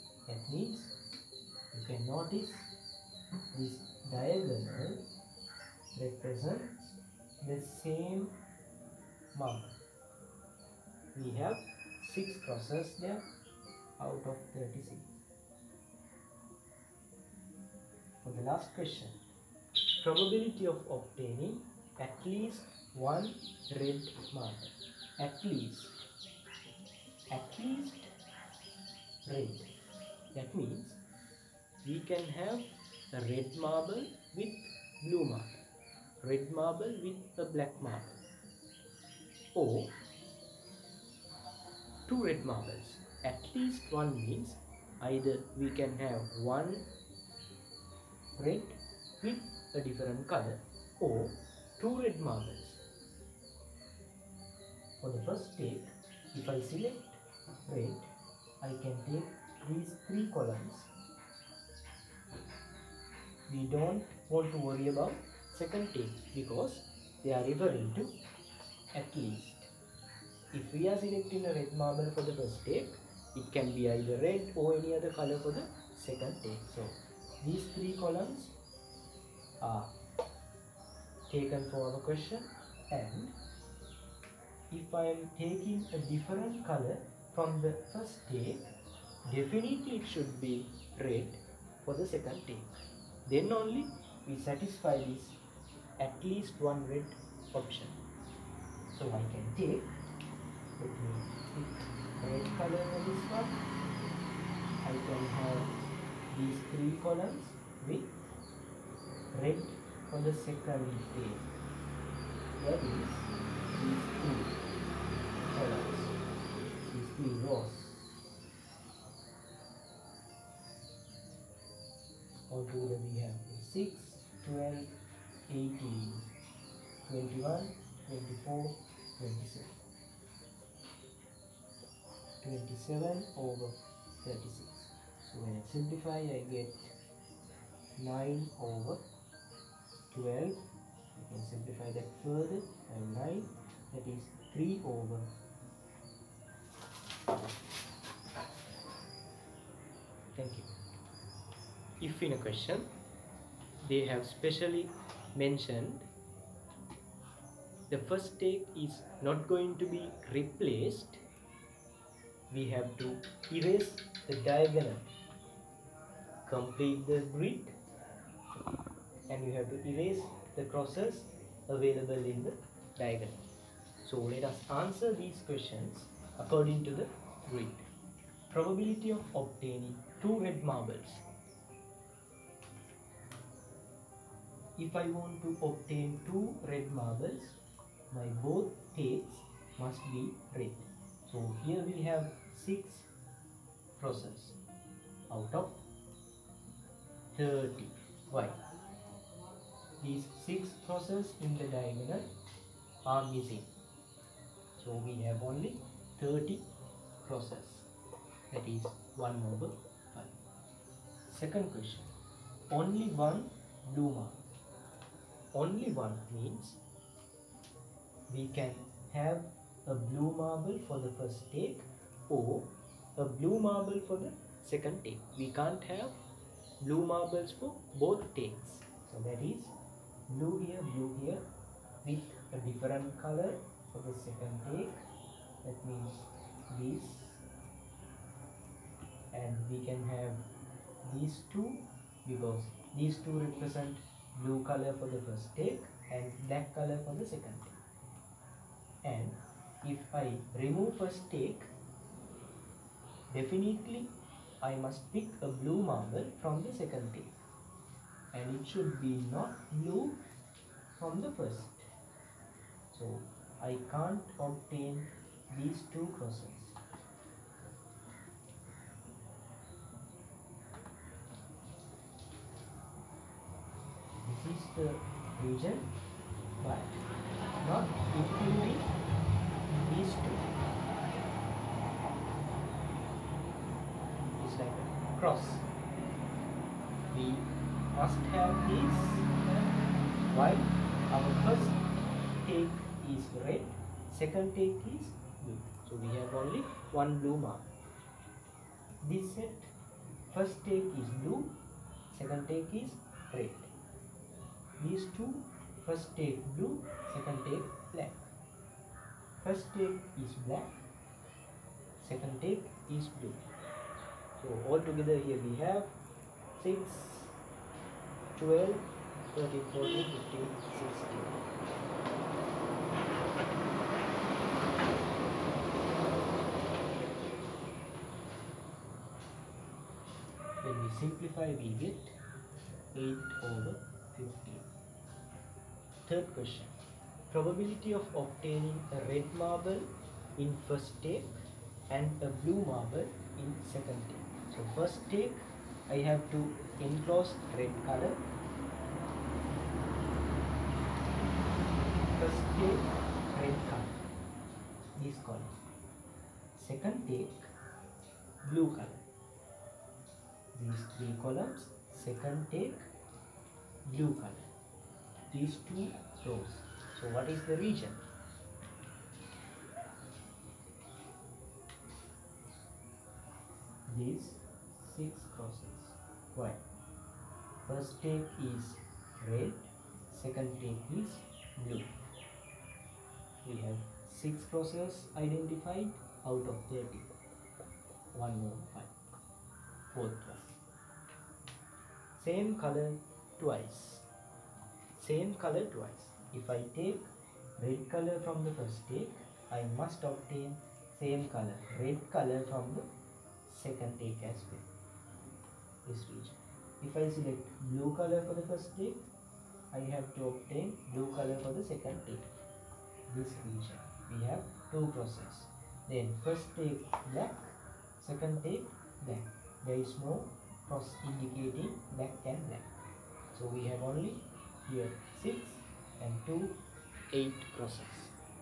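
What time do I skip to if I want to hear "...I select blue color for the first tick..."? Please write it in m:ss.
6:47.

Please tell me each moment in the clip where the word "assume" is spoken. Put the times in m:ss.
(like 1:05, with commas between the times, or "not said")
not said.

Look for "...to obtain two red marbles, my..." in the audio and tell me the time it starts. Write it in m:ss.
3:05.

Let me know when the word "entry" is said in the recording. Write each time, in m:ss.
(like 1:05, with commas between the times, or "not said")
not said.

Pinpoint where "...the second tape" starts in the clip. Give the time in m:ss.
1:15.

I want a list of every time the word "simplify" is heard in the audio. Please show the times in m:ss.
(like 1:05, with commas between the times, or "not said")
2:15, 2:21, 5:30.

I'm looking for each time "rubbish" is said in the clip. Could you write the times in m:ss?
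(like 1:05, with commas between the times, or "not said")
not said.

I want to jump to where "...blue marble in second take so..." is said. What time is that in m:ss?
5:42.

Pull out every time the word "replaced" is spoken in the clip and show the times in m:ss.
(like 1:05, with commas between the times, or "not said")
2:40.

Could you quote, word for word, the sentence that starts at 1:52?
That is these two columns, these three rows.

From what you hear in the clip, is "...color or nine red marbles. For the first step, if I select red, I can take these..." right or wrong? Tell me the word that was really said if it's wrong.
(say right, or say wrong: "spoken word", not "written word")
wrong: "two", not "nine".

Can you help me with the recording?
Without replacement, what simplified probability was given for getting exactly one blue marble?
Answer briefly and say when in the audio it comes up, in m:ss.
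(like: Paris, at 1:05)
8/15, at 5:32.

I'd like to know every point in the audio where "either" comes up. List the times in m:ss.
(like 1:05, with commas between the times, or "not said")
0:45, 1:13.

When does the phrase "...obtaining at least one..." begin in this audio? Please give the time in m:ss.
0:20.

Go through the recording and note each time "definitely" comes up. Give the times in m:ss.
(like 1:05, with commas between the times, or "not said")
1:29, 4:13.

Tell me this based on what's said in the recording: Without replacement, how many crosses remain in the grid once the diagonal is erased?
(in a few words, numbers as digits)
30.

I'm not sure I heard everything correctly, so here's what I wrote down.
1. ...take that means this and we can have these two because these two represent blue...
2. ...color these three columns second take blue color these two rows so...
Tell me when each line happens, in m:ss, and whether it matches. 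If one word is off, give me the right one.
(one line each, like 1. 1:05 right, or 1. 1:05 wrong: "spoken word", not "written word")
1. 3:54 right
2. 5:58 right.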